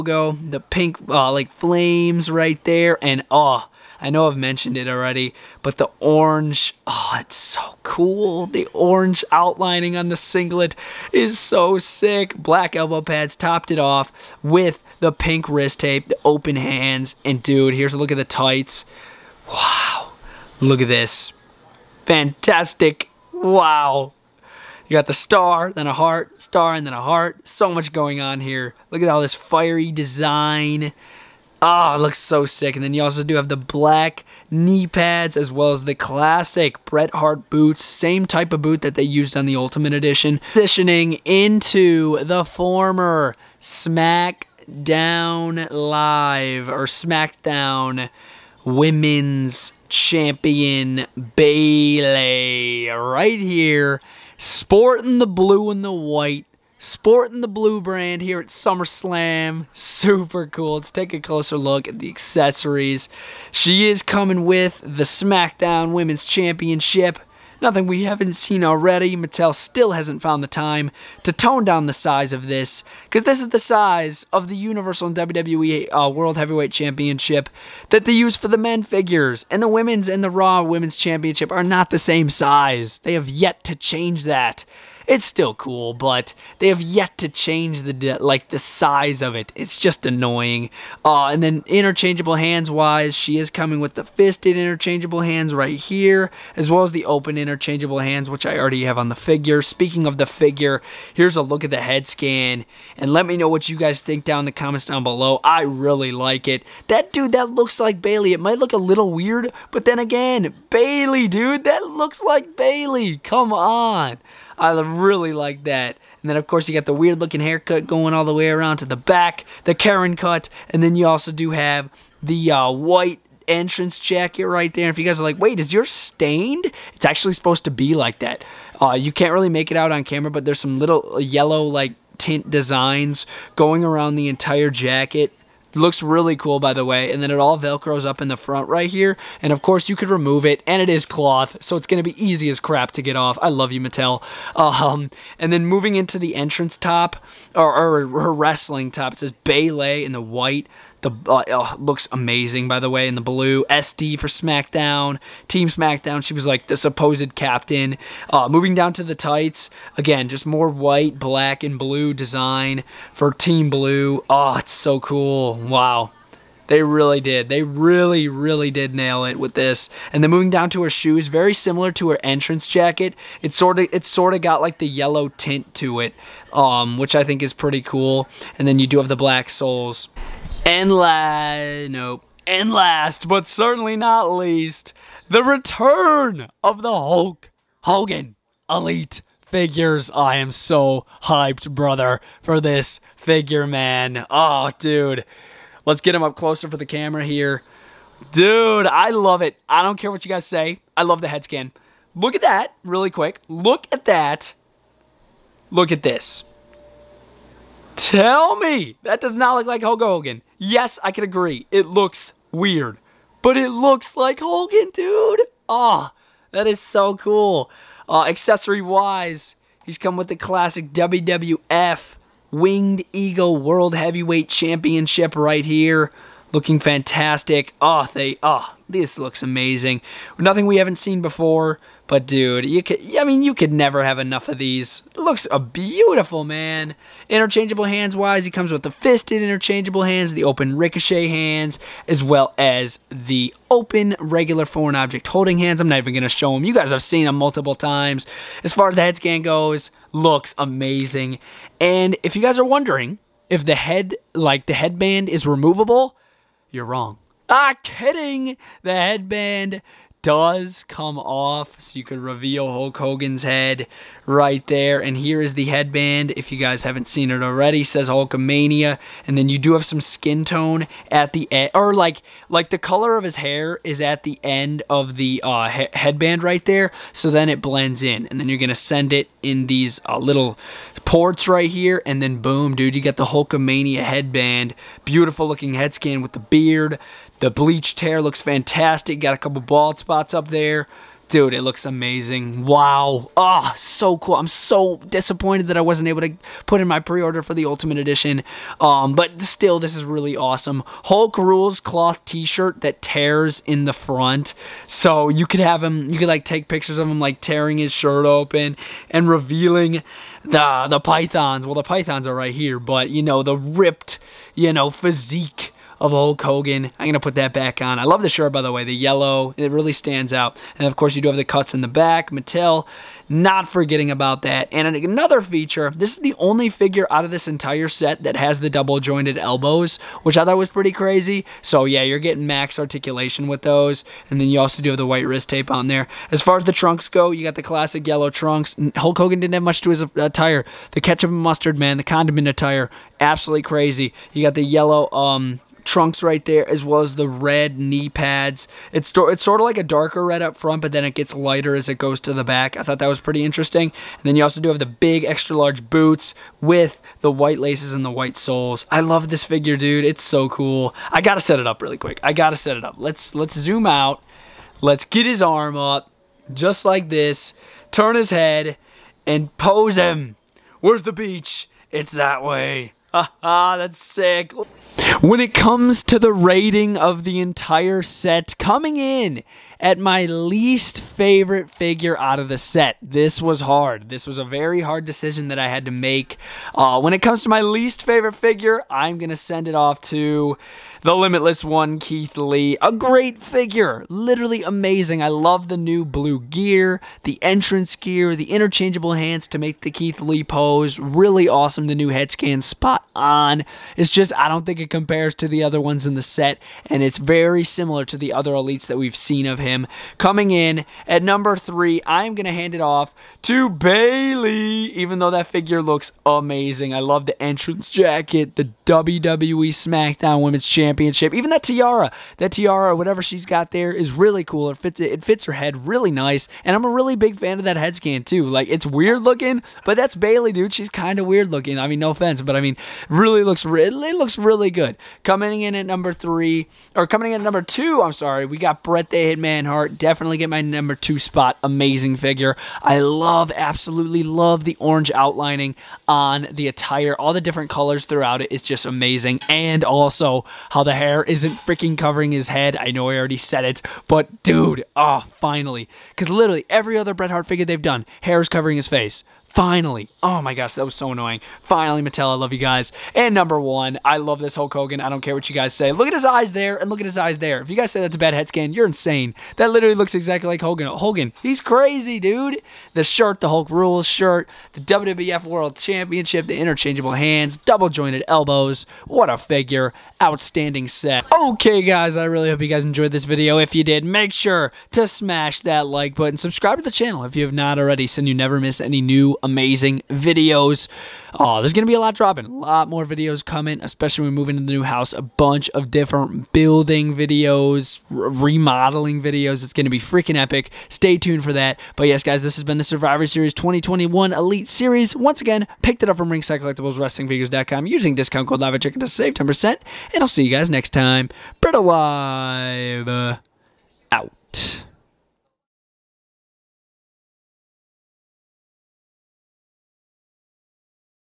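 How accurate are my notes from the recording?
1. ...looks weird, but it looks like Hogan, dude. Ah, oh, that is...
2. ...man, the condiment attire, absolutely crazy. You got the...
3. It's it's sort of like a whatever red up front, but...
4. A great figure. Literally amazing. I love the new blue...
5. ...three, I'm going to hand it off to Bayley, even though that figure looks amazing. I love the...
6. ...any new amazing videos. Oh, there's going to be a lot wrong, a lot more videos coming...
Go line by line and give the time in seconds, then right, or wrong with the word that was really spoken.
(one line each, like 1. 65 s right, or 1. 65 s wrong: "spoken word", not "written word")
1. 211 s right
2. 341 s right
3. 348 s wrong: "darker", not "whatever"
4. 392 s right
5. 411 s right
6. 488 s wrong: "dropping", not "wrong".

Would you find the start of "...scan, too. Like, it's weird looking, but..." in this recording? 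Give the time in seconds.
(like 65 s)
427 s.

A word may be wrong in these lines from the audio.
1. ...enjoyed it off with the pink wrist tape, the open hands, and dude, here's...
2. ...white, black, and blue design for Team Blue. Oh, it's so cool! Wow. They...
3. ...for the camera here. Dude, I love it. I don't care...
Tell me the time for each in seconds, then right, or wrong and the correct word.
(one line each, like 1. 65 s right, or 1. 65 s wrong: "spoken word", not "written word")
1. 13 s wrong: "topped", not "enjoyed"
2. 160 s right
3. 196 s right.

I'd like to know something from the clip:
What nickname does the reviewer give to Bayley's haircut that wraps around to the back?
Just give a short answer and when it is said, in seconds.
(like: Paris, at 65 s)
Karen cut, at 119 s.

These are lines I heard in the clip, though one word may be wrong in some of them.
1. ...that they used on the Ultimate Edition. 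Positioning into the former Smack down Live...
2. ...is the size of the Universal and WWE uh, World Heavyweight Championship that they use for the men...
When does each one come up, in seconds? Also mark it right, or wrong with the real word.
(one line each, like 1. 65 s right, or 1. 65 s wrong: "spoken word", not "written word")
1. 38 s right
2. 73 s right.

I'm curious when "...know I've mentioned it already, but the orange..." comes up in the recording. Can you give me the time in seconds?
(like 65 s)
4 s.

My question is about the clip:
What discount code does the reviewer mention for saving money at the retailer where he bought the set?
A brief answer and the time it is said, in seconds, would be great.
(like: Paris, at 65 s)
LavaChicken, at 508 s.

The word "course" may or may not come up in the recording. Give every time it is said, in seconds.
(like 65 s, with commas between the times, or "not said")
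116 s, 139 s, 320 s.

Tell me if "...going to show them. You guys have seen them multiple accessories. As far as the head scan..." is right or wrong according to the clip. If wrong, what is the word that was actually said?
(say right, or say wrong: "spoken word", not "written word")
wrong: "times", not "accessories".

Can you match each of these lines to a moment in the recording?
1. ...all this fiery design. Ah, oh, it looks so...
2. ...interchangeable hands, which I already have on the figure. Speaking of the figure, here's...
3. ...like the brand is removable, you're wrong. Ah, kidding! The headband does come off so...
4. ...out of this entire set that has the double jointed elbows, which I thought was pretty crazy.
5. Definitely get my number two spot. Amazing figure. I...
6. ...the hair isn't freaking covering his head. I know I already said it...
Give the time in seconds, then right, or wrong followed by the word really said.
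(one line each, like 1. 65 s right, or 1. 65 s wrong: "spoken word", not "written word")
1. 29 s right
2. 97 s right
3. 254 s wrong: "headband", not "brand"
4. 327 s right
5. 439 s right
6. 450 s right.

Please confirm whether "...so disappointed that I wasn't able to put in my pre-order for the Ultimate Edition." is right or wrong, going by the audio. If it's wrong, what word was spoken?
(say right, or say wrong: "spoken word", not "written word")
right.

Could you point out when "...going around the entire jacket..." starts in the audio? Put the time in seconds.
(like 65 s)
133 s.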